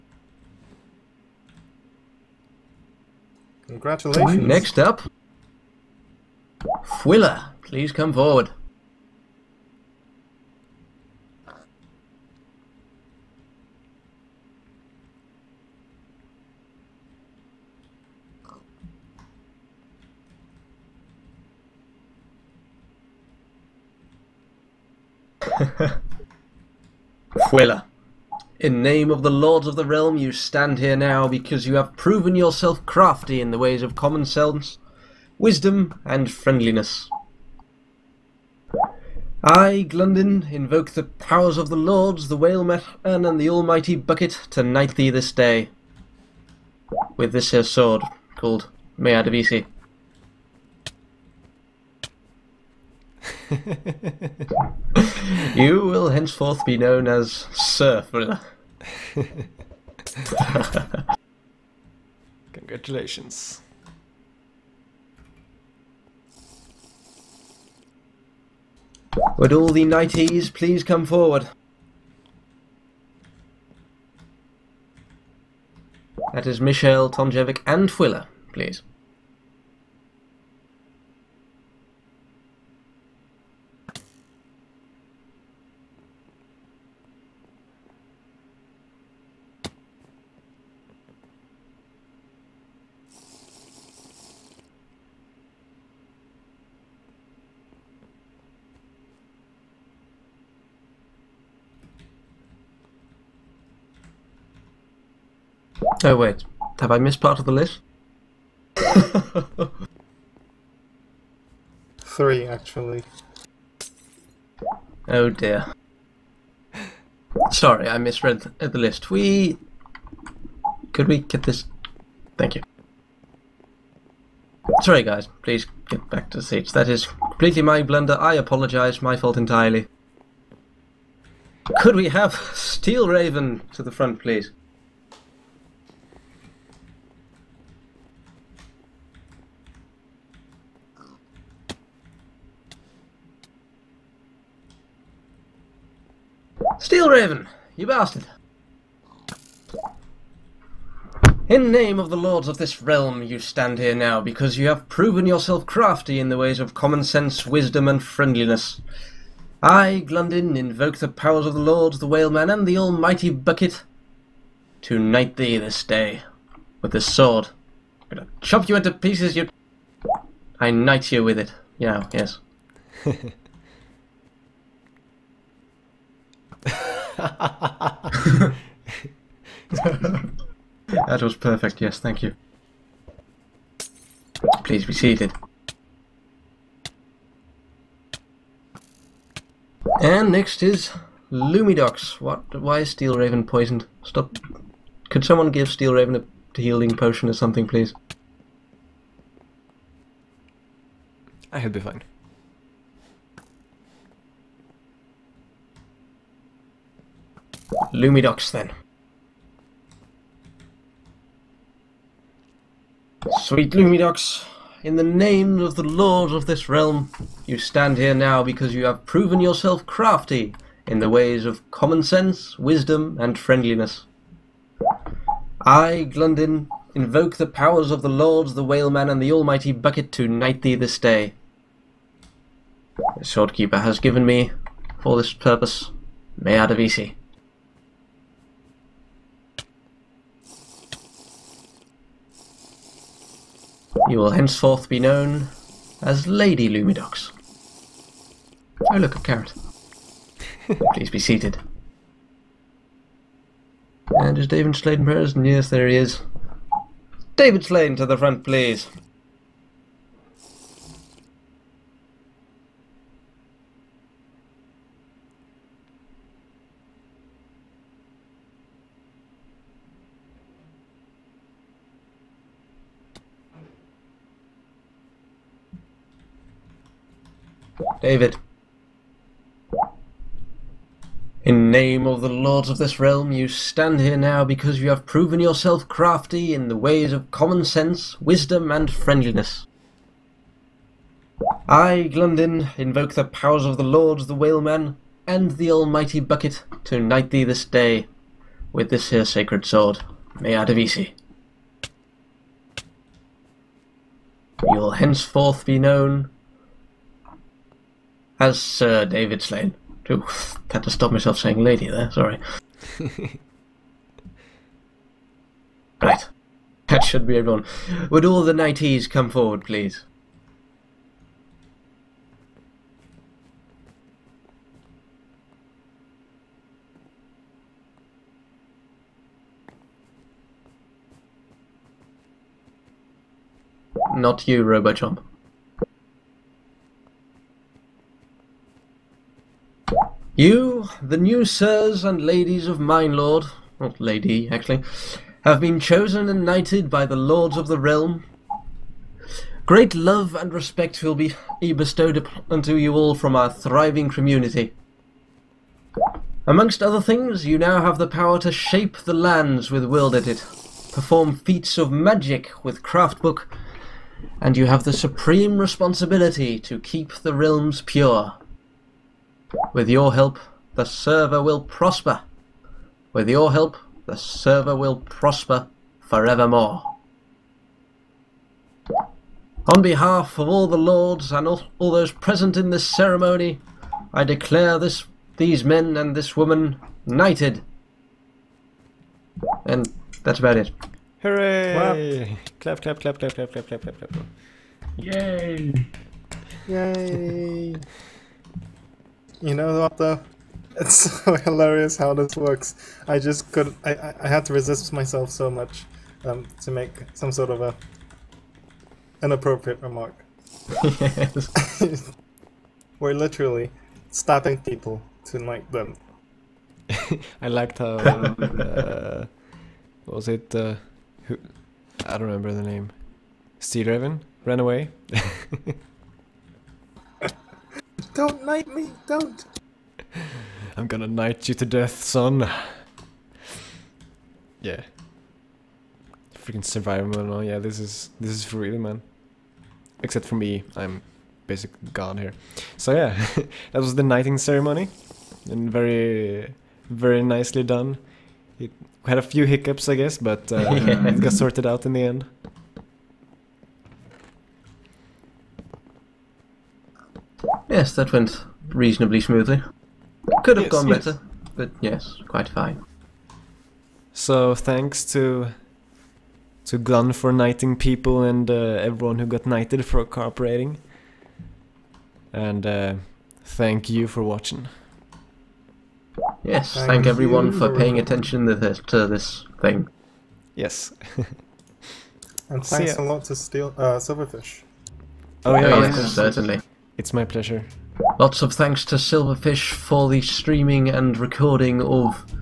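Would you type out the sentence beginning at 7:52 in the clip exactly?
And uh, thank you for watching.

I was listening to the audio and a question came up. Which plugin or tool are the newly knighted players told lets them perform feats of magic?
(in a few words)
Craftbook.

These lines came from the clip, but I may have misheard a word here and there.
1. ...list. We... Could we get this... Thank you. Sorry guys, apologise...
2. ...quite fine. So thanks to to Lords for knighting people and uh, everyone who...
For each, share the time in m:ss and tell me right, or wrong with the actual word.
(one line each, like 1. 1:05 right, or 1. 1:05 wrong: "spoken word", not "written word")
1. 1:58 wrong: "please", not "apologise"
2. 7:42 wrong: "Glun", not "Lords".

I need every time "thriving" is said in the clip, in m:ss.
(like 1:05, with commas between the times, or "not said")
5:53.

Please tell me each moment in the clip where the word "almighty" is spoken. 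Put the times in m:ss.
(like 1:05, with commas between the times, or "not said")
0:43, 2:42, 3:49, 4:55.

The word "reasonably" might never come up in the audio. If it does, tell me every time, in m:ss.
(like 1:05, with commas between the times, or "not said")
7:38.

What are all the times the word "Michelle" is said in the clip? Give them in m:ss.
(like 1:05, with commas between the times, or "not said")
1:16.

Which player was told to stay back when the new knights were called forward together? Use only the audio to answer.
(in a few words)
Robochomp.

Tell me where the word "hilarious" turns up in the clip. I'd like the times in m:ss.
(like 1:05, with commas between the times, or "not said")
6:41.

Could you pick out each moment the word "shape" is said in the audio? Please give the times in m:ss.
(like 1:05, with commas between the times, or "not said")
5:58.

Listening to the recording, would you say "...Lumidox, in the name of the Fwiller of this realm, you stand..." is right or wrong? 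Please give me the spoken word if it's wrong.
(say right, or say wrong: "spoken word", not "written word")
wrong: "Lord", not "Fwiller".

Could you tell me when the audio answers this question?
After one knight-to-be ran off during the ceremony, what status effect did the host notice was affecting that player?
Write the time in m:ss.
3:13.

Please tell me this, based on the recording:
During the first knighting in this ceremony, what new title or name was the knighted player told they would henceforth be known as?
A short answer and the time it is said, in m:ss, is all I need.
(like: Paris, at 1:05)
Surfer, at 0:57.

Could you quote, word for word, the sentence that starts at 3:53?
The Swordkeeper has given me, for this purpose, Meadavisi.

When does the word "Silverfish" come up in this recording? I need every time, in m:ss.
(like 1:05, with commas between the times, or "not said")
8:03, 8:08.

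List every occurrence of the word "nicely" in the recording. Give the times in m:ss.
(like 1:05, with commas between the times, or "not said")
7:27.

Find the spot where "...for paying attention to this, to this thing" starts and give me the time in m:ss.
7:57.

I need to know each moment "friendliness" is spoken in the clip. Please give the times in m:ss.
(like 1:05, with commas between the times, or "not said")
0:36, 2:38, 3:43, 4:48.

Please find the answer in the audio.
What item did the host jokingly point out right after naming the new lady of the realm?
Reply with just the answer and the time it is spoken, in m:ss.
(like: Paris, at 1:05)
a carrot, at 4:09.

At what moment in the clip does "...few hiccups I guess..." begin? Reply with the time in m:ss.
7:29.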